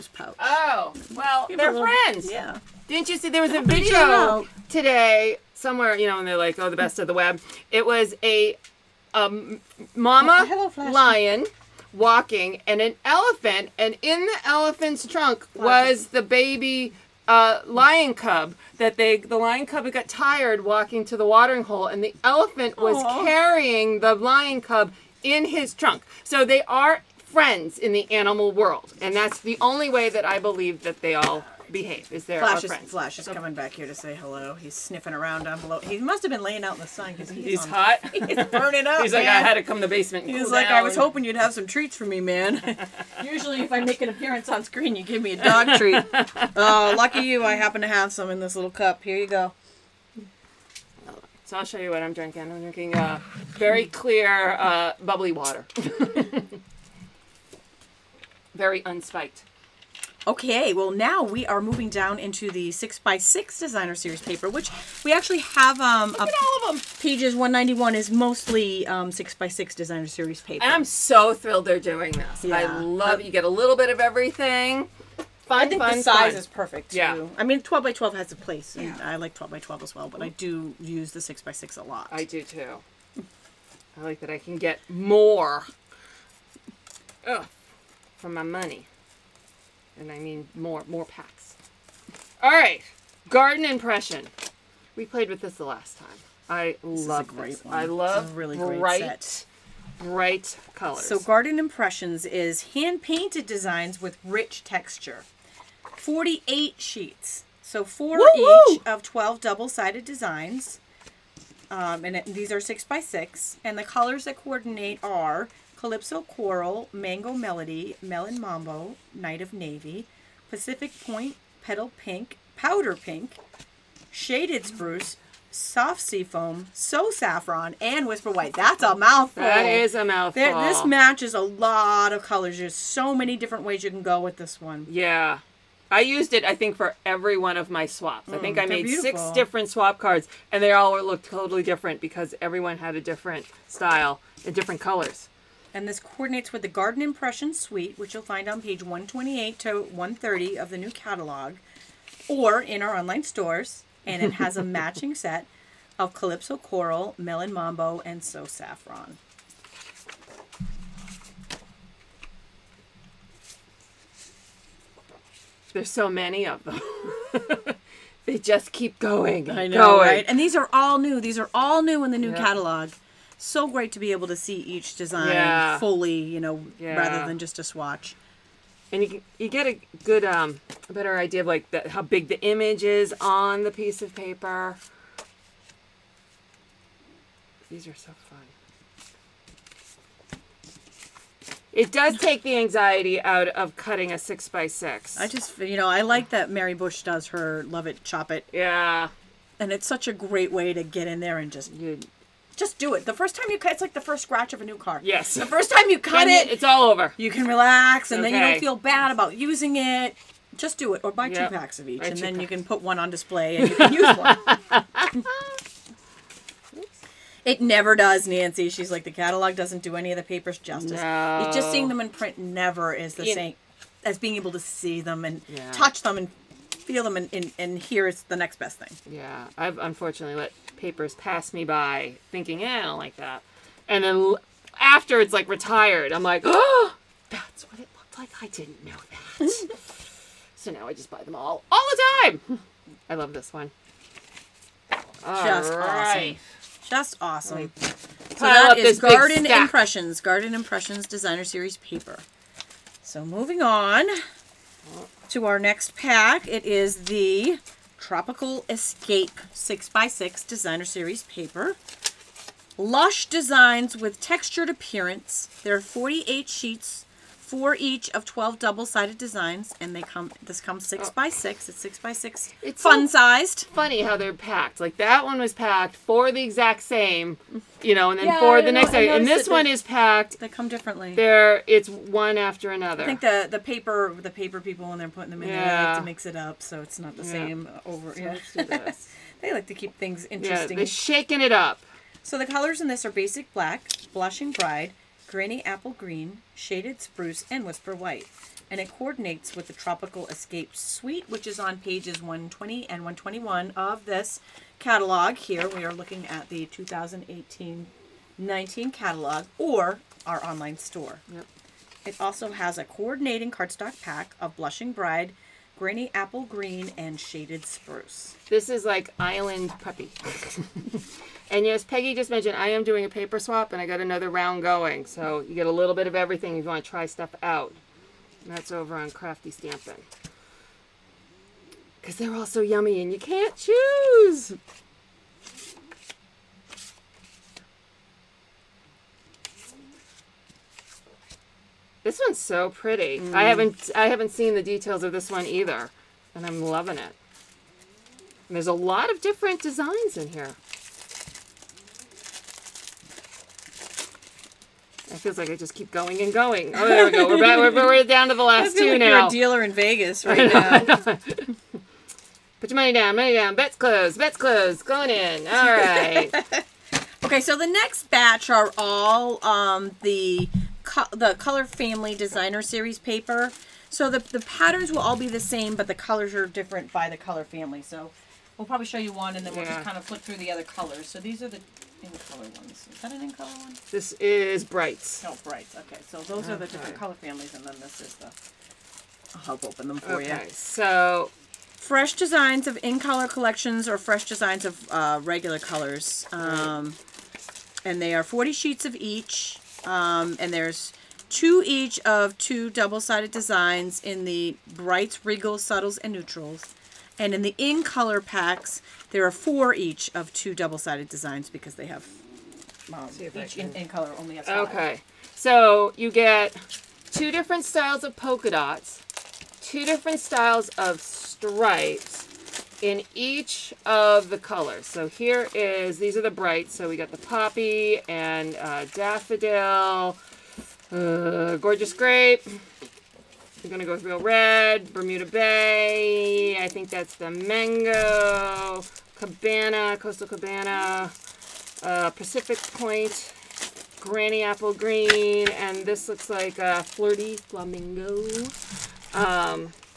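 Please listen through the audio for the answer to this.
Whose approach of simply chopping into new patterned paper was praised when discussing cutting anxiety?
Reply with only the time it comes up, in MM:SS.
03:16.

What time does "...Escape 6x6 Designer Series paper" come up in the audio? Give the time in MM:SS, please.
04:18.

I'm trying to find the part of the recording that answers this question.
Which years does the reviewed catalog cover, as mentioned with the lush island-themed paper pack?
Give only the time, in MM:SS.
05:06.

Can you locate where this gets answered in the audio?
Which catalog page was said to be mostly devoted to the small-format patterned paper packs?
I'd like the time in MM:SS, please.
01:07.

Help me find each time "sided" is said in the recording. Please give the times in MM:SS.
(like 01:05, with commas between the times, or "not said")
01:49, 04:28, 06:43, 06:50.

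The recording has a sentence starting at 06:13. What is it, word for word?
So the the patterns will all be the same, but the colors are different by the color family.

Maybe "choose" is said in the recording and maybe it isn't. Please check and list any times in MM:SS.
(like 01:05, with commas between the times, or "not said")
05:33.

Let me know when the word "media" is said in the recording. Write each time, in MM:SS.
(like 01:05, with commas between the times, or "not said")
not said.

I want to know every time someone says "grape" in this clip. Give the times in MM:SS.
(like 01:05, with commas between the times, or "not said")
07:11.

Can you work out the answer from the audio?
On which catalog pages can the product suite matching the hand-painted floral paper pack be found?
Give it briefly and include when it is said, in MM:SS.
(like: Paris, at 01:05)
128 to 130, at 02:28.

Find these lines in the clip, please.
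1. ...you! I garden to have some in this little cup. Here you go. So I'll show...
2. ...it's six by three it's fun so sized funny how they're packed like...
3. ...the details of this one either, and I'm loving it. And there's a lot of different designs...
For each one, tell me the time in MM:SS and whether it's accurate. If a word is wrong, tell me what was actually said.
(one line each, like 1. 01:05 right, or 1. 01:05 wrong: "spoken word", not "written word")
1. 00:47 wrong: "happen", not "garden"
2. 04:31 wrong: "six", not "three"
3. 05:44 right.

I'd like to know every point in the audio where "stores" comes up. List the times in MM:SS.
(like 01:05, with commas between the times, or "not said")
02:33, 05:10.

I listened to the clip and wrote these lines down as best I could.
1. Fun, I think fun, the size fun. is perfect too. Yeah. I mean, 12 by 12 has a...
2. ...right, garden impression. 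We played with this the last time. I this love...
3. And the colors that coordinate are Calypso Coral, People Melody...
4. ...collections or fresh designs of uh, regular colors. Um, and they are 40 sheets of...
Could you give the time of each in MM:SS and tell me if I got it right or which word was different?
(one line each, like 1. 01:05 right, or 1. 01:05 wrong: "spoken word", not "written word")
1. 01:15 right
2. 01:32 right
3. 01:53 wrong: "Mango", not "People"
4. 06:33 right.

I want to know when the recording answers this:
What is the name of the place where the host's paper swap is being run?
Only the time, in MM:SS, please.
05:29.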